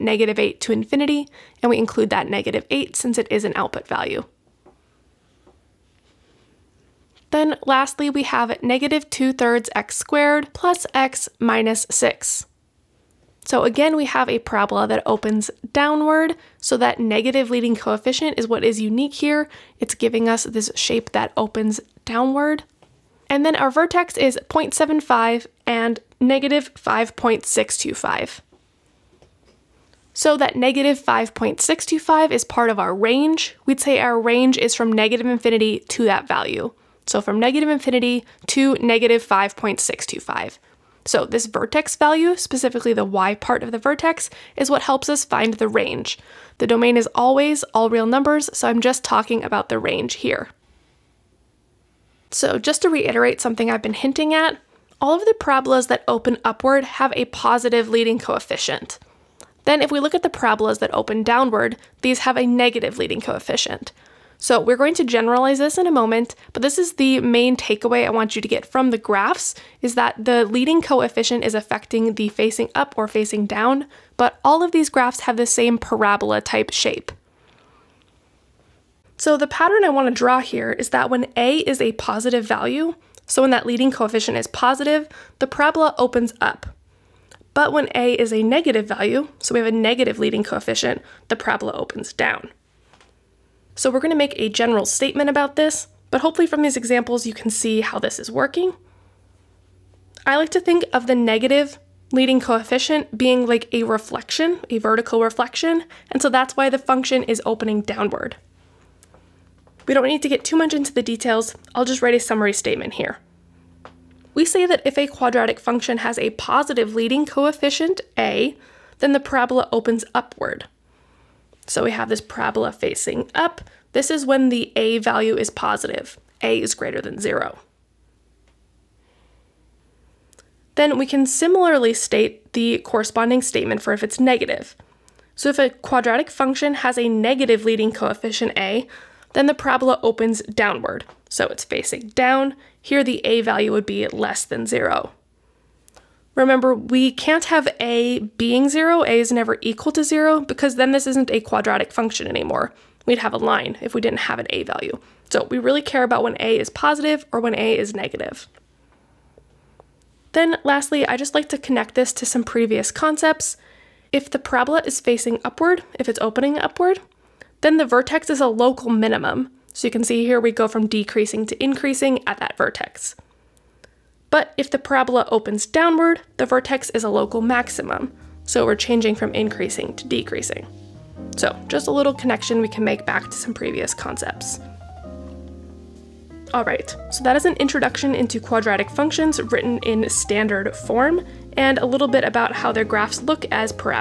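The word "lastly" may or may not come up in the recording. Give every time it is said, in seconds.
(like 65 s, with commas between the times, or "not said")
7 s, 160 s.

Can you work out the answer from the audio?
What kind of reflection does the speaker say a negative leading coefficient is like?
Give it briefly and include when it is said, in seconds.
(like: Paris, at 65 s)
A vertical reflection, at 104 s.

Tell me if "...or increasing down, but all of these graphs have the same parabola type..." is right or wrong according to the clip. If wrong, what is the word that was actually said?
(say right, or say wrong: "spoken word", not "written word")
wrong: "facing", not "increasing".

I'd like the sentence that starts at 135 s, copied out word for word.
So if a quadratic function has a negative leading coefficient a, then the parabola opens downward.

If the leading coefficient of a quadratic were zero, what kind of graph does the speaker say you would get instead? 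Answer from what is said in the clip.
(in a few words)
A line.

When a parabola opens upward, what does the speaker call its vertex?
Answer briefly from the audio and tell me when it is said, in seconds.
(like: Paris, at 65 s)
A local minimum, at 168 s.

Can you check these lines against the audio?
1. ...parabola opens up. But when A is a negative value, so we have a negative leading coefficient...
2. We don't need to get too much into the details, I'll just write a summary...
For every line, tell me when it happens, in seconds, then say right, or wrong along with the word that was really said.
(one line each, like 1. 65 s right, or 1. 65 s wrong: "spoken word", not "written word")
1. 85 s right
2. 109 s right.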